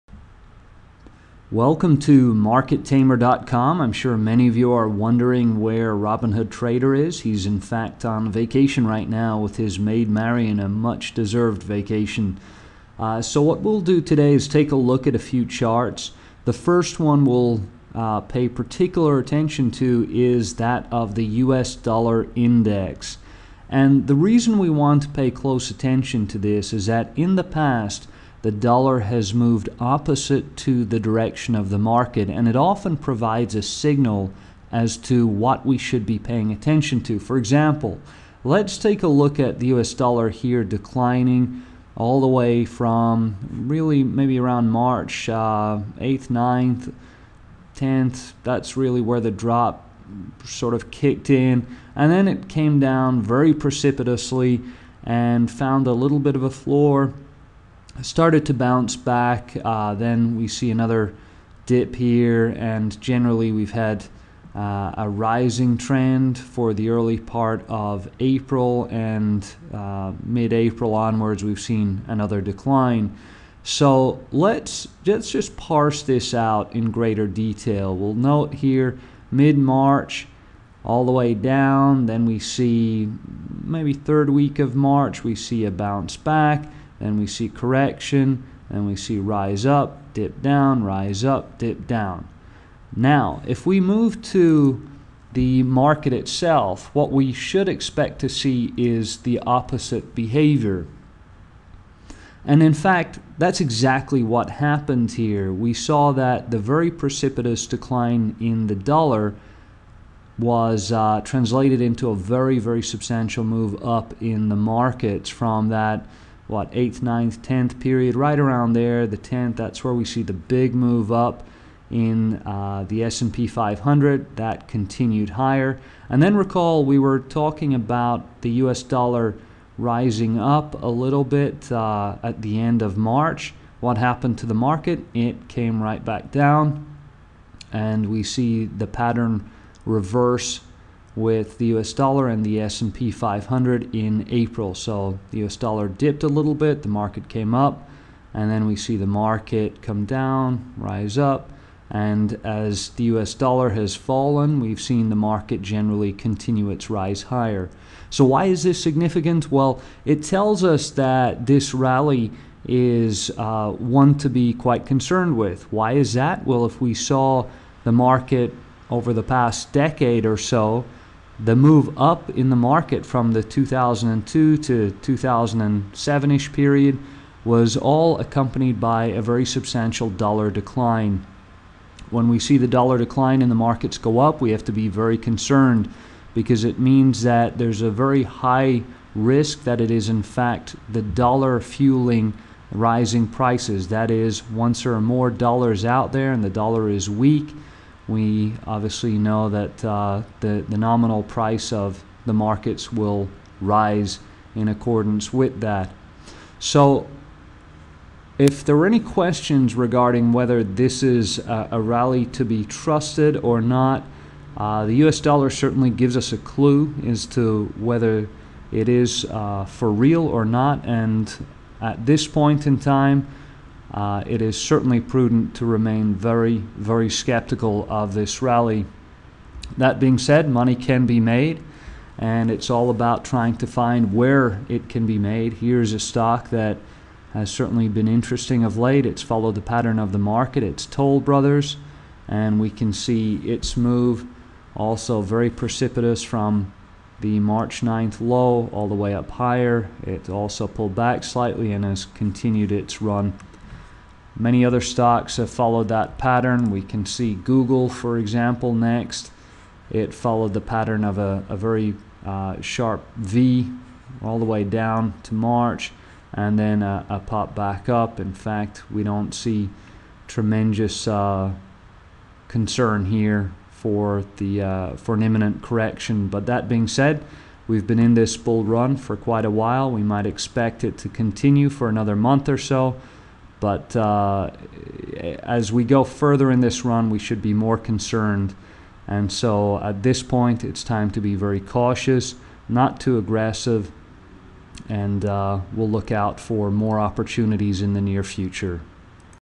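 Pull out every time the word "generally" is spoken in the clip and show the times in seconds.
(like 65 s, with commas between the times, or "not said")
63 s, 155 s.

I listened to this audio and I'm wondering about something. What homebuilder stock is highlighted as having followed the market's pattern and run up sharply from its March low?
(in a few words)
Toll Brothers.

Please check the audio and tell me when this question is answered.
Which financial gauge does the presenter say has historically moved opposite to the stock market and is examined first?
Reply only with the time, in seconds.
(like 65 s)
21 s.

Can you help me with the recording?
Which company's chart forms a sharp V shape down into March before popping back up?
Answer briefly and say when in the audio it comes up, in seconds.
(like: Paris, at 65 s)
Google, at 257 s.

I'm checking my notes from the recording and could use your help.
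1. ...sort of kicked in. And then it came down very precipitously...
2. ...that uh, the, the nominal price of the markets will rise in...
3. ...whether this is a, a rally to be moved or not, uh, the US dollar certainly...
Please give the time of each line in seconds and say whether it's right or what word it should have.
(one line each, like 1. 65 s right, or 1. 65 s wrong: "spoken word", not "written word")
1. 50 s right
2. 199 s right
3. 210 s wrong: "trusted", not "moved".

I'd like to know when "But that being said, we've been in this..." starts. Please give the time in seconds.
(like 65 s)
276 s.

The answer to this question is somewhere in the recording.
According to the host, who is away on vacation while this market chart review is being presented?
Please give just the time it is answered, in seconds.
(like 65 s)
5 s.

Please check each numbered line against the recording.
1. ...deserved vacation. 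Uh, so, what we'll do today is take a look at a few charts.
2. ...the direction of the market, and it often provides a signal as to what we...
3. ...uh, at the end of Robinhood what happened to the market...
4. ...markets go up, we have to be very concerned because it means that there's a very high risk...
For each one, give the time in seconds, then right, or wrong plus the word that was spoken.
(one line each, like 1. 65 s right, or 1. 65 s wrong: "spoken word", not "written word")
1. 11 s right
2. 30 s right
3. 131 s wrong: "March", not "Robinhood"
4. 183 s right.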